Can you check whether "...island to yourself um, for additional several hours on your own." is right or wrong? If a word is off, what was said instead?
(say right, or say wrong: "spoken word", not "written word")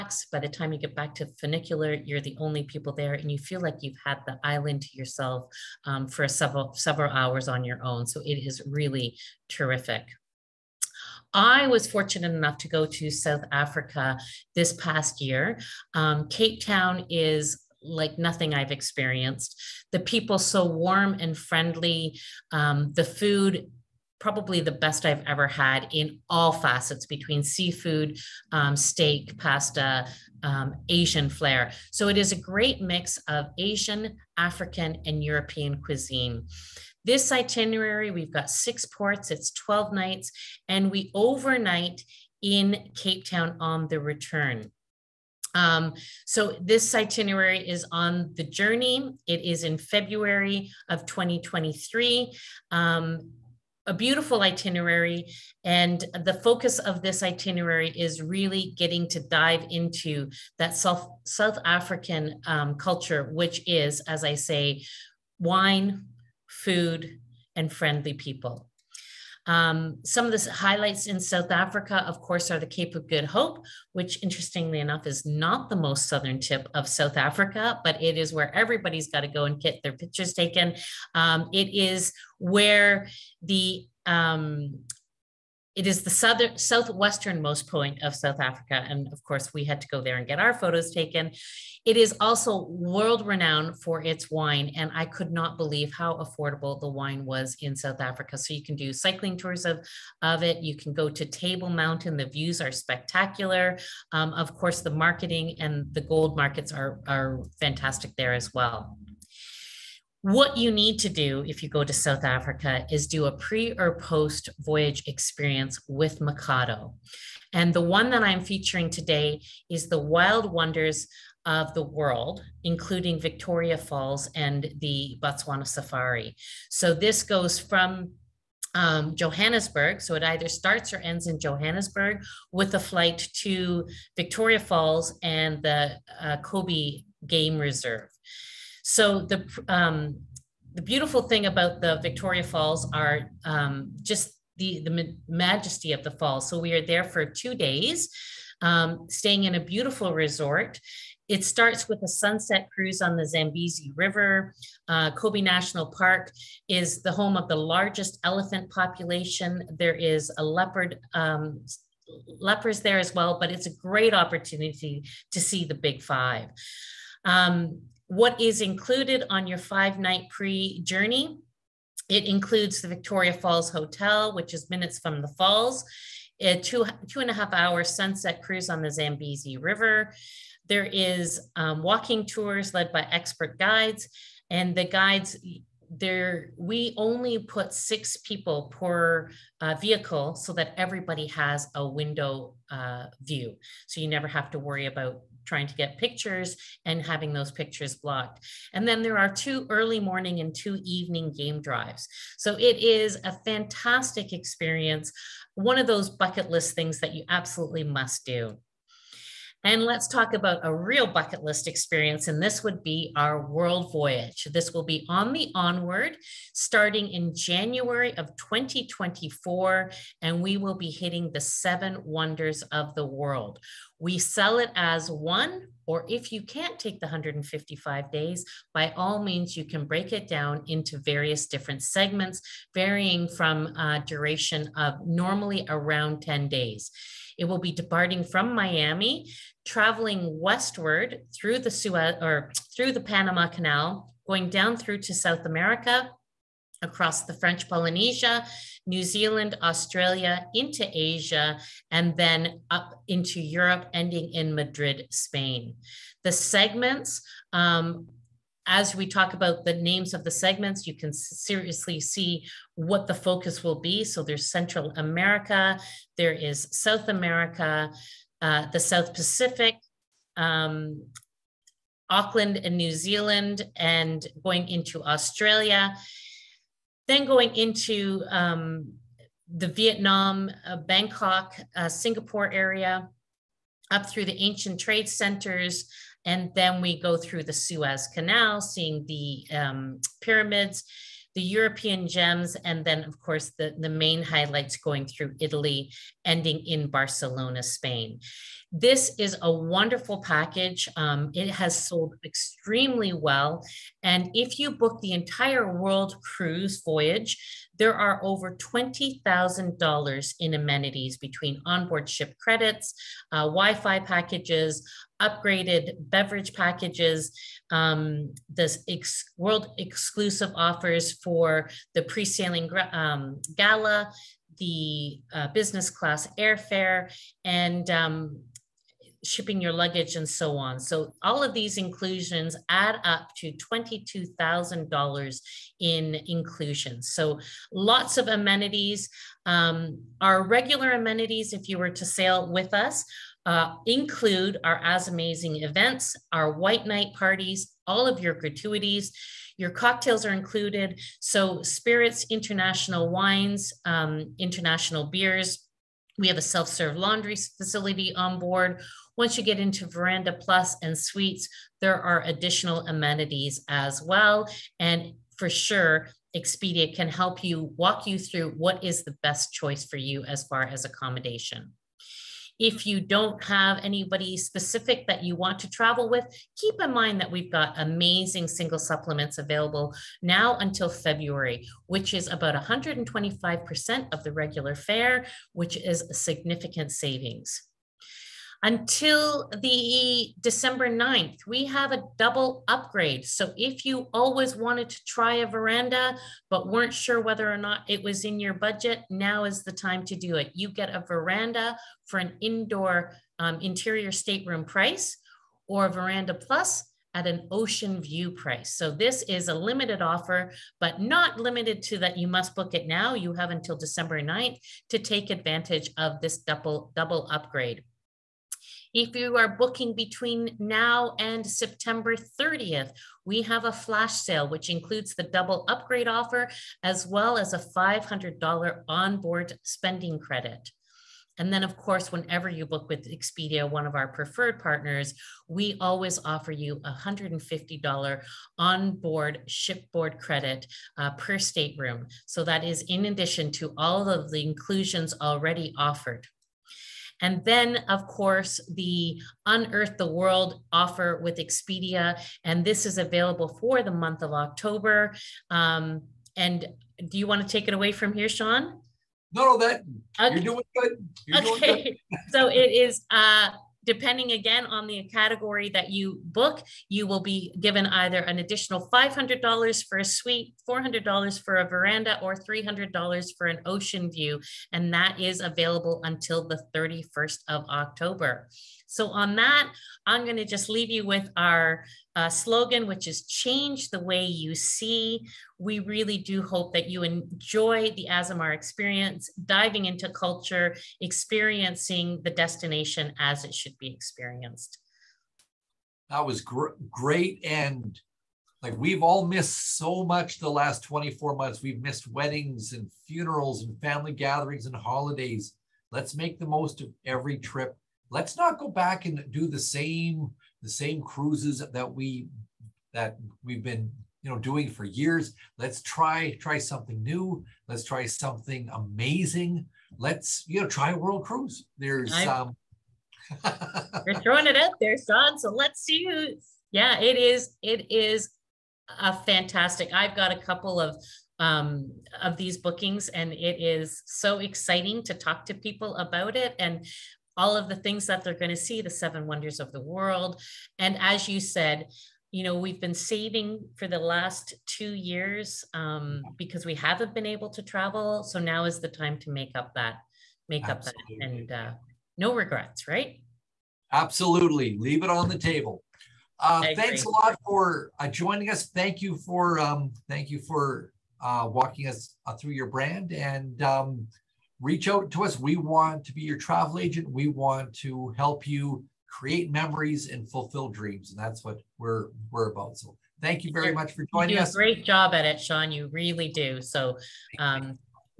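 wrong: "several", not "additional".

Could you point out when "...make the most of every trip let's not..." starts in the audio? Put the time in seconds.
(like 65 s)
506 s.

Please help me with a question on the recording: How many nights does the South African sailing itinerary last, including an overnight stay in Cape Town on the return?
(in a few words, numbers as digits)
12.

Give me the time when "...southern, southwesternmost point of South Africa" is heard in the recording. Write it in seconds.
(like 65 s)
86 s.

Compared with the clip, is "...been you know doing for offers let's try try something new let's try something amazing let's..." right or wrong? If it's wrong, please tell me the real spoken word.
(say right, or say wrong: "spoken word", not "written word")
wrong: "years", not "offers".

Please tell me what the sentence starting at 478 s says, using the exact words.
So, on that, I'm going to just leave you with our uh, slogan, which is change the way you see.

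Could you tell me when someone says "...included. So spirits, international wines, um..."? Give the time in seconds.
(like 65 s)
350 s.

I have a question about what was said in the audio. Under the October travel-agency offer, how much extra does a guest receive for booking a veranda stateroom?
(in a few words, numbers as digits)
$400.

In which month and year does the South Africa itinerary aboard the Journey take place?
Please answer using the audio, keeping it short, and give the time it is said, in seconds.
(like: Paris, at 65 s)
February 2023, at 49 s.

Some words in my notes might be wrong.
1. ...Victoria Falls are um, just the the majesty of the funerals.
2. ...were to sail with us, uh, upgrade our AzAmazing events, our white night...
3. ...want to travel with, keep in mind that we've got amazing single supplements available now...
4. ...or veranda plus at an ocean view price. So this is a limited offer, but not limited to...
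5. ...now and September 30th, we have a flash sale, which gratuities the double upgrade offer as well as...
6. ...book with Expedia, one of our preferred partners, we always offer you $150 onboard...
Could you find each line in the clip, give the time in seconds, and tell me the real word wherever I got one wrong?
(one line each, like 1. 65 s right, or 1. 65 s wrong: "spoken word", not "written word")
1. 142 s wrong: "falls", not "funerals"
2. 341 s wrong: "include", not "upgrade"
3. 375 s right
4. 405 s right
5. 420 s wrong: "includes", not "gratuities"
6. 432 s right.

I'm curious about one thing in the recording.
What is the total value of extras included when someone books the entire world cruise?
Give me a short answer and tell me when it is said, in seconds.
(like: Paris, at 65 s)
$22,000, at 333 s.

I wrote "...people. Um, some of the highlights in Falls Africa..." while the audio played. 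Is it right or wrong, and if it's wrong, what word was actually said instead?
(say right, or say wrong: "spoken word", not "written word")
wrong: "South", not "Falls".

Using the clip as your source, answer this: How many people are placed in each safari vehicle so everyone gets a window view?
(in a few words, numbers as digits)
6.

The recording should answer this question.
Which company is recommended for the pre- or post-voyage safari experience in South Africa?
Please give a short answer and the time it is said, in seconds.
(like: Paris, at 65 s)
Micato, at 116 s.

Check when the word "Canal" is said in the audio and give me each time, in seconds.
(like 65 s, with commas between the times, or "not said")
243 s, 288 s.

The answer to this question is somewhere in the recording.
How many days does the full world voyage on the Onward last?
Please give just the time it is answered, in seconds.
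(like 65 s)
227 s.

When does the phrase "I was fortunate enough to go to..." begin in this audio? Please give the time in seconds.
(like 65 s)
11 s.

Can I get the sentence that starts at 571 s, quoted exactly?
And that's what we're we're about.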